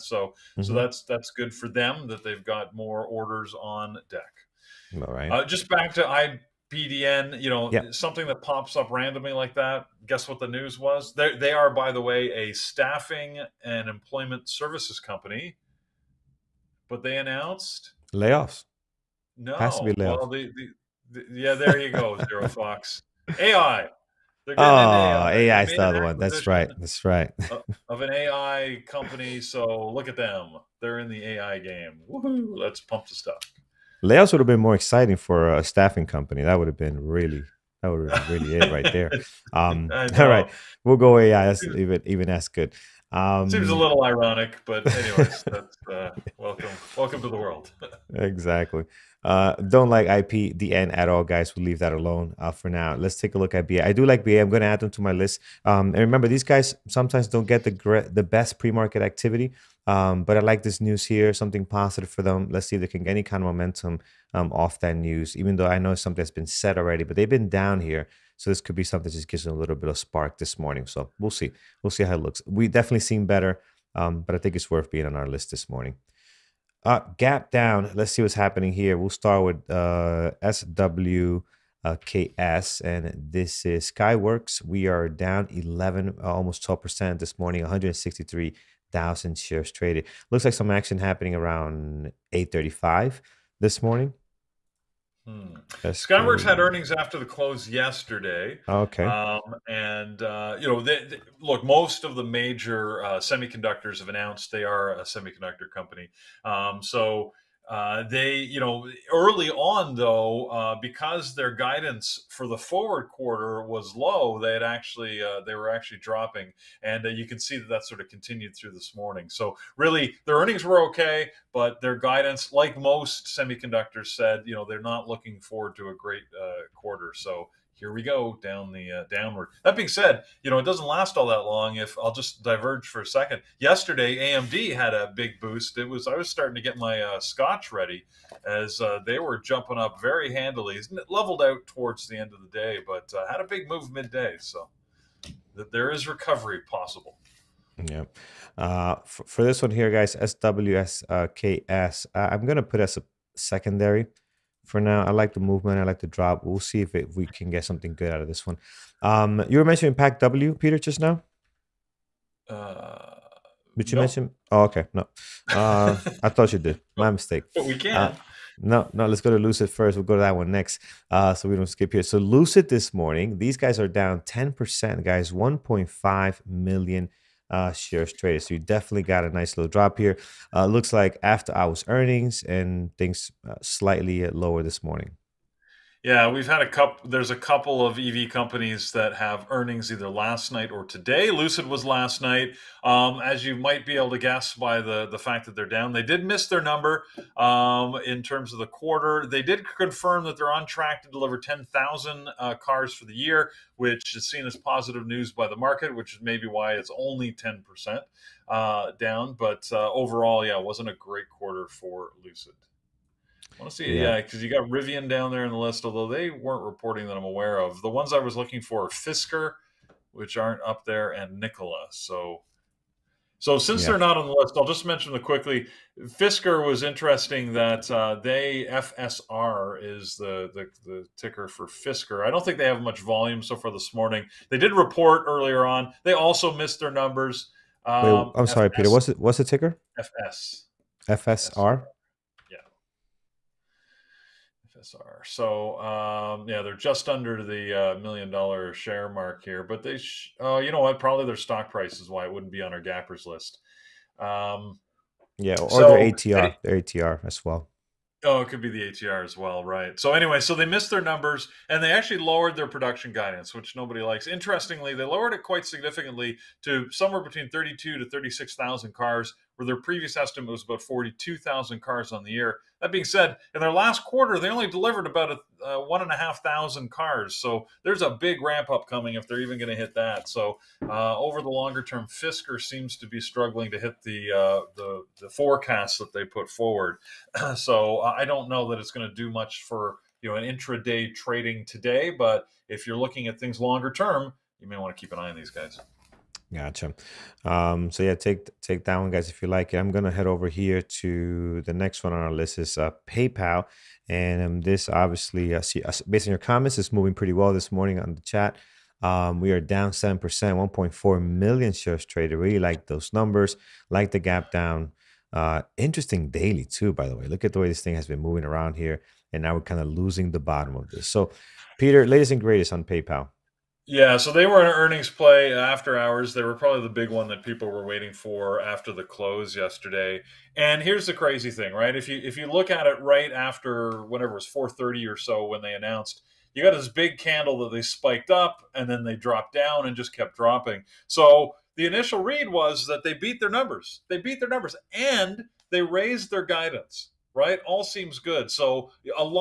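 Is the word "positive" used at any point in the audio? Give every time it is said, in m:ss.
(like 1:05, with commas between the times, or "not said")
1:01, 3:24.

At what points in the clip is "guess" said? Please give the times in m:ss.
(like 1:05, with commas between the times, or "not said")
0:10, 3:14.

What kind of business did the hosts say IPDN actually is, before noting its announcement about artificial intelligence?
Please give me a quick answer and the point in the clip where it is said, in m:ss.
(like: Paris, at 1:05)
Staffing and employment services, at 0:12.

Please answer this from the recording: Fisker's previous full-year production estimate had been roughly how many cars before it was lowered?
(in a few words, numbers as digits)
42,000.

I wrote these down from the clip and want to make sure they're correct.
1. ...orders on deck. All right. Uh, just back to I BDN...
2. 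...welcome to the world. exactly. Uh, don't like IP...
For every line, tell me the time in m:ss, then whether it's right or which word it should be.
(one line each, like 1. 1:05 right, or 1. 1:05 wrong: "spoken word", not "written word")
1. 0:03 right
2. 0:46 right.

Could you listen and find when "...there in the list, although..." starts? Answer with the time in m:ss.
3:35.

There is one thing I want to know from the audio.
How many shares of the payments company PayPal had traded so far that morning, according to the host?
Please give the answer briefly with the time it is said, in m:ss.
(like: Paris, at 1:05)
1.4 million, at 5:10.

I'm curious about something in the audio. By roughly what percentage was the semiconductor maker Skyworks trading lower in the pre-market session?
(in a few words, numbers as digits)
11%.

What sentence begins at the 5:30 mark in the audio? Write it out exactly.
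And here's the crazy thing, right?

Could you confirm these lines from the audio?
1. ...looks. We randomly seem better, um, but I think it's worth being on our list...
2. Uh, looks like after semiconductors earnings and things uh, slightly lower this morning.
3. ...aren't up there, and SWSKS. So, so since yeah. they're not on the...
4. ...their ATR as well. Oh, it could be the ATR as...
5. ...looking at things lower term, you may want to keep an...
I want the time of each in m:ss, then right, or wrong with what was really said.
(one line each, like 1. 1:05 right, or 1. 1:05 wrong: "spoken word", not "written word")
1. 1:12 wrong: "definitely", not "randomly"
2. 3:00 wrong: "hours", not "semiconductors"
3. 3:40 wrong: "Nikola", not "SWSKS"
4. 4:16 right
5. 4:52 wrong: "longer", not "lower".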